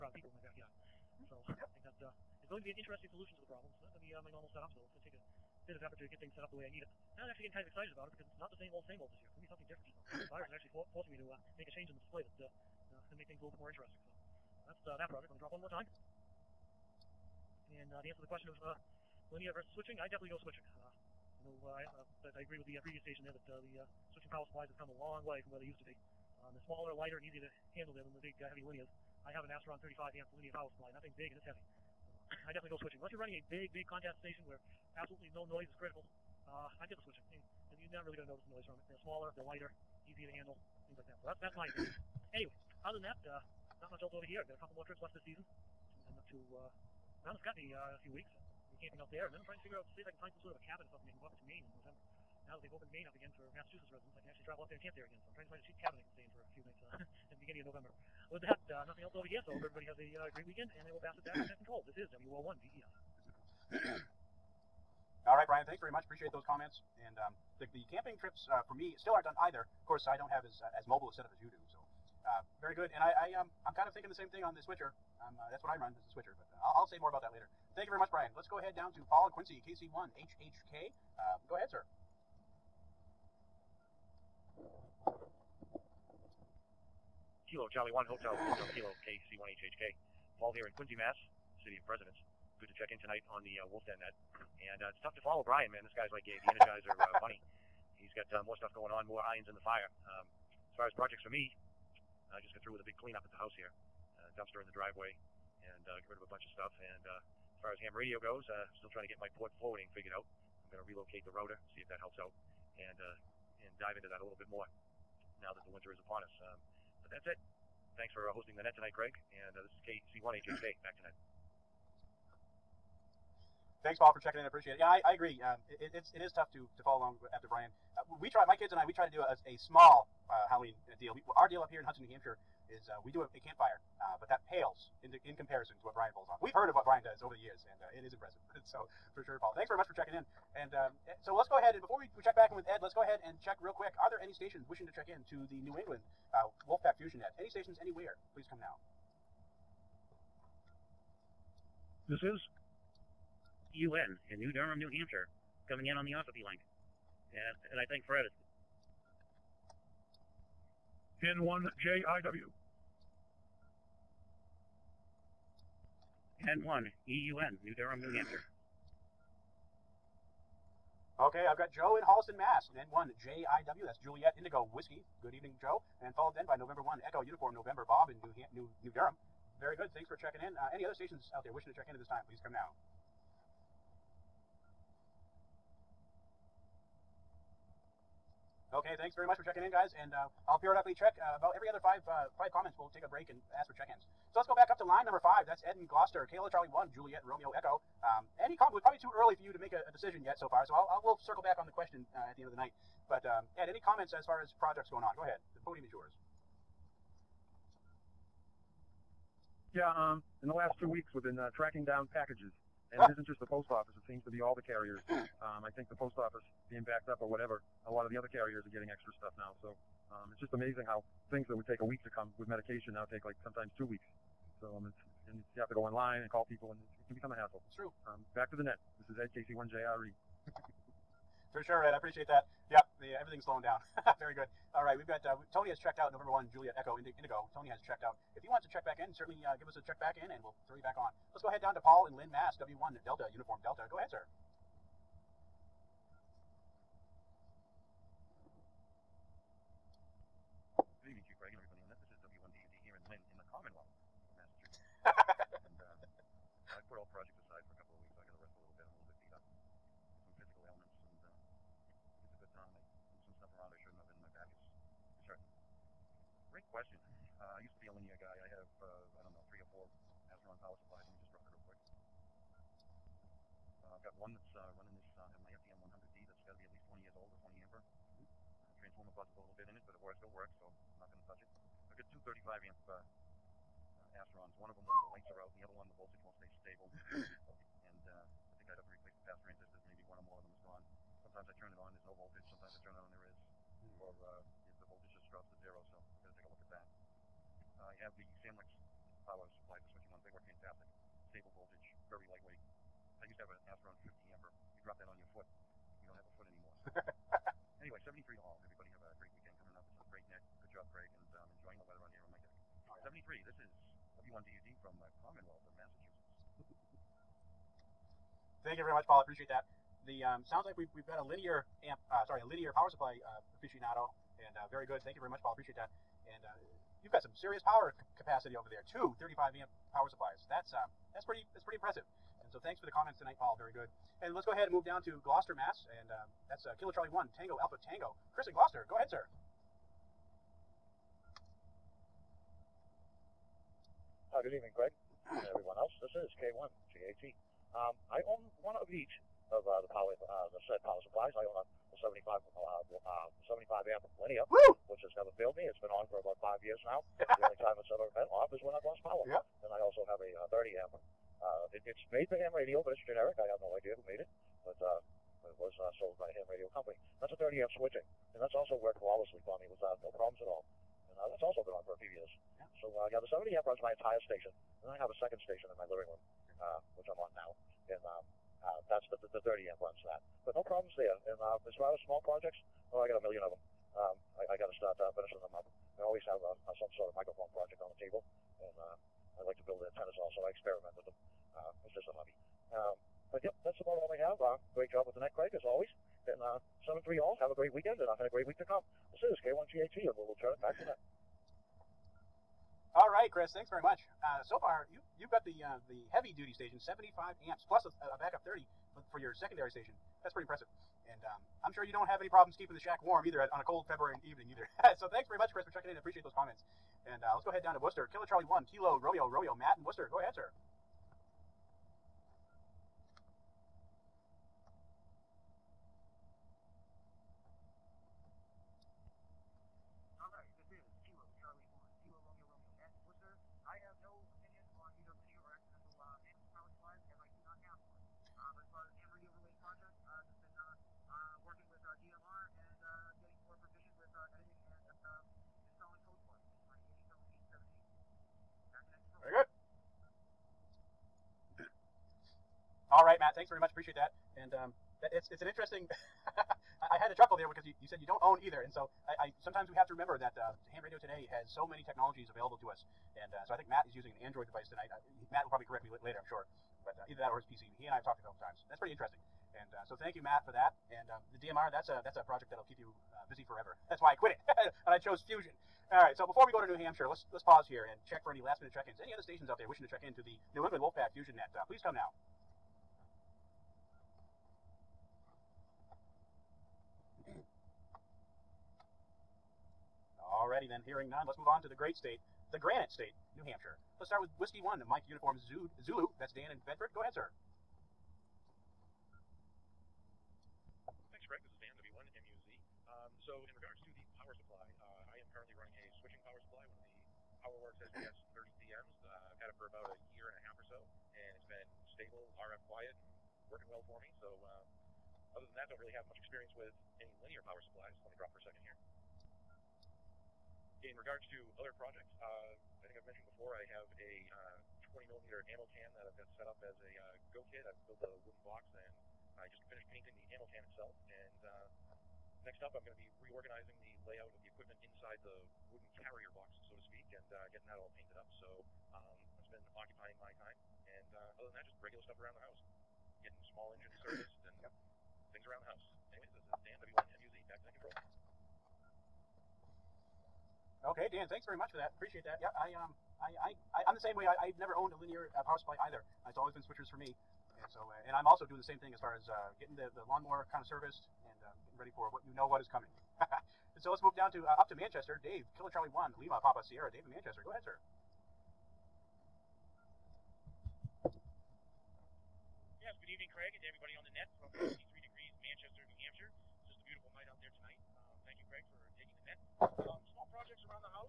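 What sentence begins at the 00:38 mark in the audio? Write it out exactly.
They're smaller, they're lighter, easier to handle things like that.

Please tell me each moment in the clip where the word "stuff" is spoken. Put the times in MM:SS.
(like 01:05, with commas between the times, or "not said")
01:38, 01:46, 03:39, 09:02.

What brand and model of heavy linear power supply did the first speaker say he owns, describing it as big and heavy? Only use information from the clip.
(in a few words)
Astron 35.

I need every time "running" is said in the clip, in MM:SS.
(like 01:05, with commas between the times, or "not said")
00:33, 04:34.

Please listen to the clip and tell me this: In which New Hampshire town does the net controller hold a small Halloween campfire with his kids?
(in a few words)
Hudson.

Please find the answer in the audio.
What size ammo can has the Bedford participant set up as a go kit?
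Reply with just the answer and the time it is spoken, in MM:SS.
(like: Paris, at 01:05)
20 millimeter, at 08:44.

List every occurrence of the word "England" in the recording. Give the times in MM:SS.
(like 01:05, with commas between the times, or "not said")
02:25, 08:00.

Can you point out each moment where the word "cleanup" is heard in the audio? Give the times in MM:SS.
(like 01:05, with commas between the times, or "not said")
01:42.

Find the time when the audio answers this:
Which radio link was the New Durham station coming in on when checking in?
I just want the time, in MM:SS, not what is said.
02:36.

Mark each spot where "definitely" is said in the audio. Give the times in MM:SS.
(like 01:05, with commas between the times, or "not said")
00:20, 00:32.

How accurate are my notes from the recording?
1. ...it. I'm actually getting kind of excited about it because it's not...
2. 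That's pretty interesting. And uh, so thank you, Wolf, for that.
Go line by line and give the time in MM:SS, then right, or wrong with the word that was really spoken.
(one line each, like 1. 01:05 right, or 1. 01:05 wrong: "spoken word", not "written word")
1. 00:06 right
2. 07:48 wrong: "Matt", not "Wolf".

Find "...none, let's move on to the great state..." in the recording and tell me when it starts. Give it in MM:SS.
08:11.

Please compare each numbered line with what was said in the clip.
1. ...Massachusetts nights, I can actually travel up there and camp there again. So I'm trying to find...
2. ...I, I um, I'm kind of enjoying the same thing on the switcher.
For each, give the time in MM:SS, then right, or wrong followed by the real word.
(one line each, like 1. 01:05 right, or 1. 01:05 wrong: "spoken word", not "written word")
1. 00:53 wrong: "residents", not "nights"
2. 01:13 wrong: "thinking", not "enjoying".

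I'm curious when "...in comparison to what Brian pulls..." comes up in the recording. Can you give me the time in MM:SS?
02:15.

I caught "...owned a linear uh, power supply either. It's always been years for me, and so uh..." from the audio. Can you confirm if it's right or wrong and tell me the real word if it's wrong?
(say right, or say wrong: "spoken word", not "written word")
wrong: "switchers", not "years".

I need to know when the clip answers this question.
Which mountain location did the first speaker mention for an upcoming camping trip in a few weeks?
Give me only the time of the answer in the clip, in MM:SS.
00:47.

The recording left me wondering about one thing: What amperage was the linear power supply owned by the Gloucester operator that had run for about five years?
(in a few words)
75 amp.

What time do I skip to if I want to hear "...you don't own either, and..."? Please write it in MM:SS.
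07:38.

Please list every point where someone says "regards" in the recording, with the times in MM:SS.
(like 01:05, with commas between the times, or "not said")
08:40.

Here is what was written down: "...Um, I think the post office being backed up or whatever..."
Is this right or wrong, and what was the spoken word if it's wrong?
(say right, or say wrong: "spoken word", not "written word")
right.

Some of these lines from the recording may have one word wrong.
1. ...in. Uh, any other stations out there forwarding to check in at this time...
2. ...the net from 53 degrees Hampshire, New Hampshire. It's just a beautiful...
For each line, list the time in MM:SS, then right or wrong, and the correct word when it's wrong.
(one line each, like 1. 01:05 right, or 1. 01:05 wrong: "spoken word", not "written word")
1. 03:00 wrong: "wishing", not "forwarding"
2. 09:34 wrong: "Manchester", not "Hampshire".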